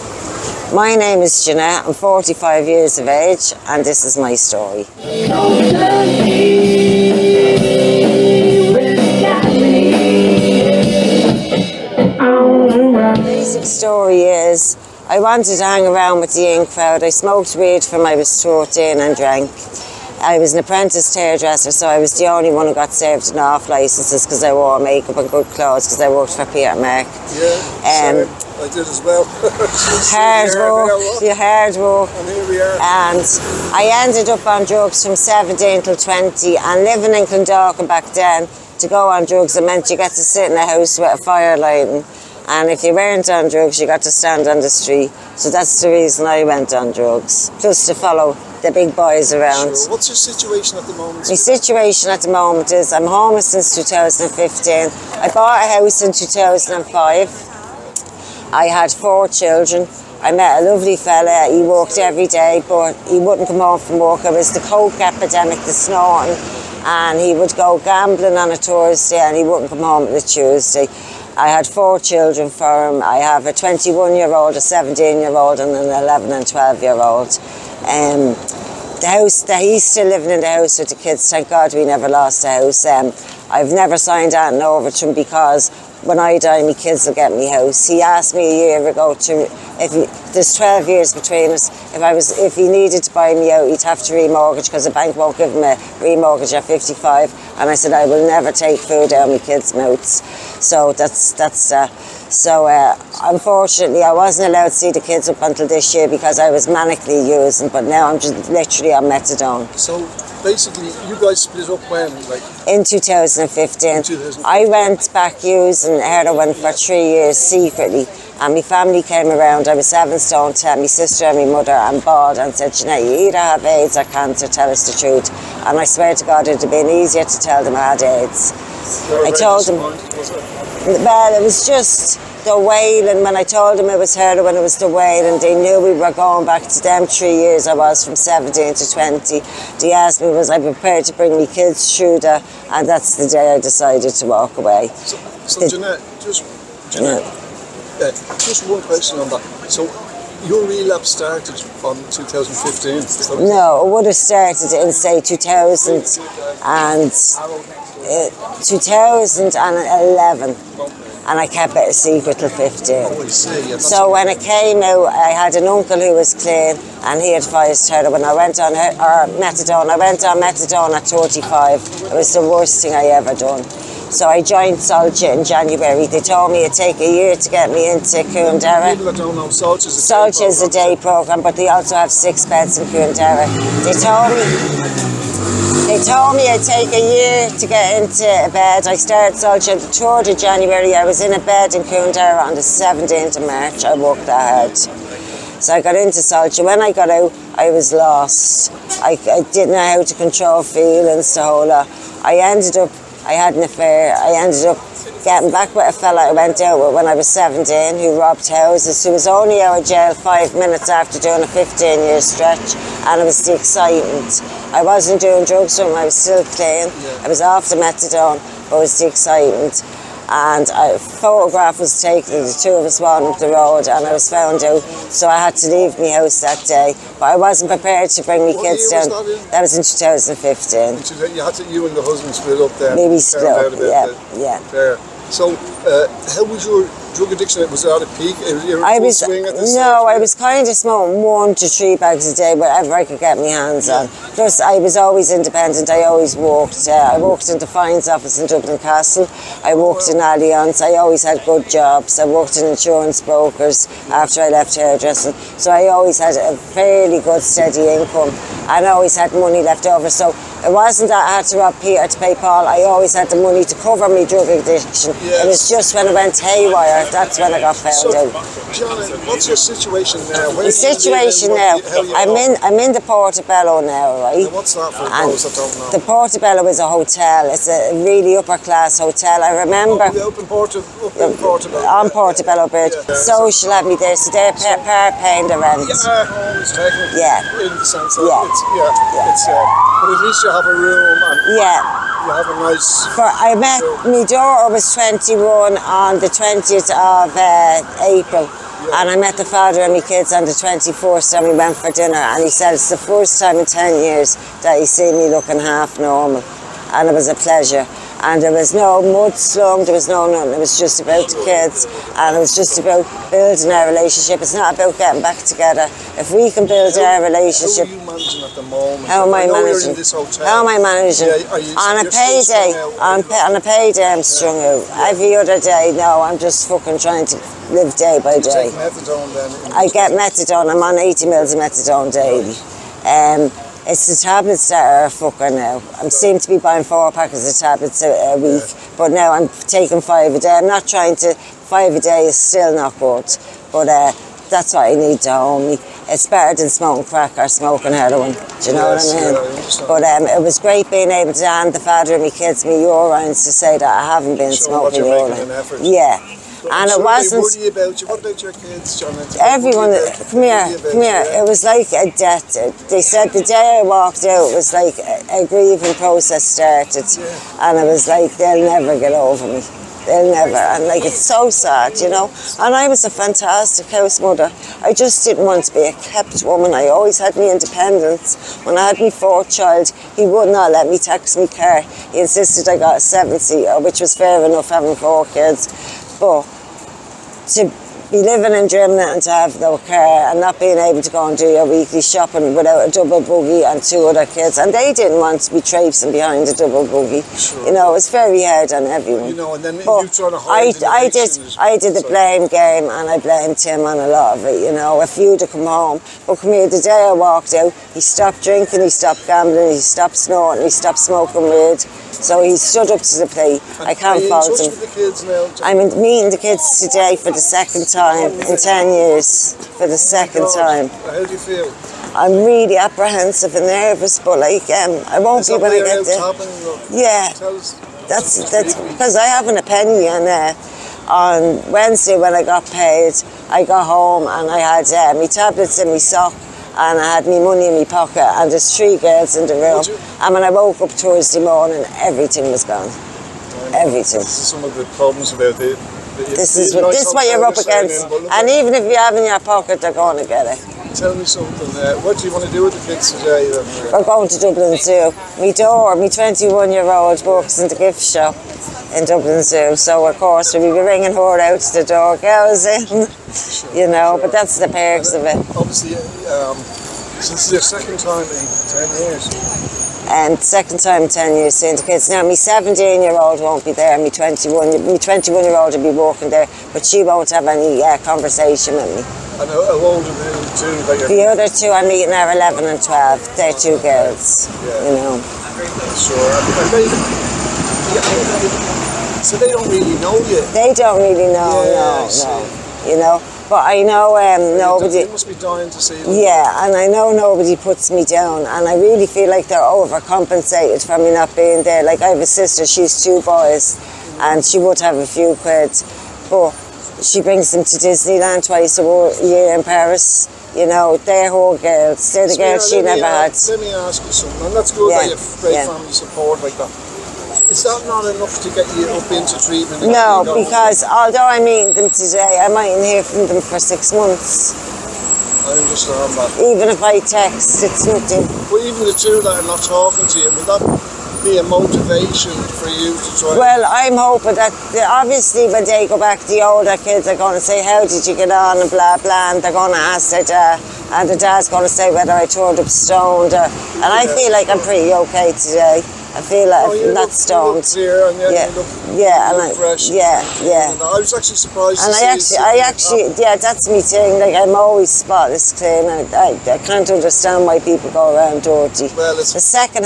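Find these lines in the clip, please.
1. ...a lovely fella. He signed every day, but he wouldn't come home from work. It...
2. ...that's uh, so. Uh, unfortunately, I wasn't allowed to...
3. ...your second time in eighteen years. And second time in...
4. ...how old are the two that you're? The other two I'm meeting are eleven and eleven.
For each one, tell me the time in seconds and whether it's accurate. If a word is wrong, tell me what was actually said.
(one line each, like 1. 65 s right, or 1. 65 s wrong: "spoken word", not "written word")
1. 60 s wrong: "worked", not "signed"
2. 101 s right
3. 467 s wrong: "ten", not "eighteen"
4. 479 s wrong: "twelve", not "eleven".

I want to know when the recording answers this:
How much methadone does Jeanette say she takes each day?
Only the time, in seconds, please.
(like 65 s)
330 s.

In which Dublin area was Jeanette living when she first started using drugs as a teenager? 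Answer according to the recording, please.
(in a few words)
Clondalkin.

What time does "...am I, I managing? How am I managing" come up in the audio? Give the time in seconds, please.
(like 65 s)
319 s.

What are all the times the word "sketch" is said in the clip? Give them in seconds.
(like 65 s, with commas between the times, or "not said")
not said.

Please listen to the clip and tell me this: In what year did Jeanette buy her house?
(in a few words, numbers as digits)
2005.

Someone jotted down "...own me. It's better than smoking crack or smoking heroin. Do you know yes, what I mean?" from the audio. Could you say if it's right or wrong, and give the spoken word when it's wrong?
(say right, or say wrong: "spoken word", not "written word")
right.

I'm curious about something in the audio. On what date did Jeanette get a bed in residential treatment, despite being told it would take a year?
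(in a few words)
17th of March.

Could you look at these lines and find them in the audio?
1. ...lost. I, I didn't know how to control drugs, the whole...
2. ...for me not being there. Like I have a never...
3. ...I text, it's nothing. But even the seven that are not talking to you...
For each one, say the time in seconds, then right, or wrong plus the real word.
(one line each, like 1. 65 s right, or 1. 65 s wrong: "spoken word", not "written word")
1. 197 s wrong: "feelings", not "drugs"
2. 500 s wrong: "sister", not "never"
3. 526 s wrong: "two", not "seven".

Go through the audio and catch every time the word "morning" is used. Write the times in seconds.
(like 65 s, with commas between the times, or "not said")
441 s.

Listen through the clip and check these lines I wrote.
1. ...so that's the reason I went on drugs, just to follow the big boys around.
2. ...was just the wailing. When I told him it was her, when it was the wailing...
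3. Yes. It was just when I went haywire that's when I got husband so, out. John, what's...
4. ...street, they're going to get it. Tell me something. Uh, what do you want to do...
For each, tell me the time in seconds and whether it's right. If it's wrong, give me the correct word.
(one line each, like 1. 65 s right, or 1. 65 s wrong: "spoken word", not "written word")
1. 45 s right
2. 131 s right
3. 265 s wrong: "found", not "husband"
4. 449 s wrong: "pocket", not "street".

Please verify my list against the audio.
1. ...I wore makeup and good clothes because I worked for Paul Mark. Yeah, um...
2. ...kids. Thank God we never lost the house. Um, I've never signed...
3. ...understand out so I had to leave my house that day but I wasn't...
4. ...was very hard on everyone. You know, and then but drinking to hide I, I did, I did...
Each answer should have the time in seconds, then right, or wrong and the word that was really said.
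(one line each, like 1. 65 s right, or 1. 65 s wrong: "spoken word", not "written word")
1. 24 s wrong: "Peter", not "Paul"
2. 80 s right
3. 224 s wrong: "found", not "understand"
4. 397 s wrong: "trying", not "drinking".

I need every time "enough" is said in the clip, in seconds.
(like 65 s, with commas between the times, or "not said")
384 s, 518 s.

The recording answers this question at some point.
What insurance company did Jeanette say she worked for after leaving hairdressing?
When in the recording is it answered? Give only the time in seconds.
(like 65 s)
250 s.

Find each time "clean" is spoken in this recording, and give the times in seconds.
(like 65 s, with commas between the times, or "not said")
166 s, 216 s, 555 s.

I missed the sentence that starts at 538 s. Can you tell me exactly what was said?
and blah blah, and they're going to ask their dad, uh, and the dad's going to say whether I turned up stoned.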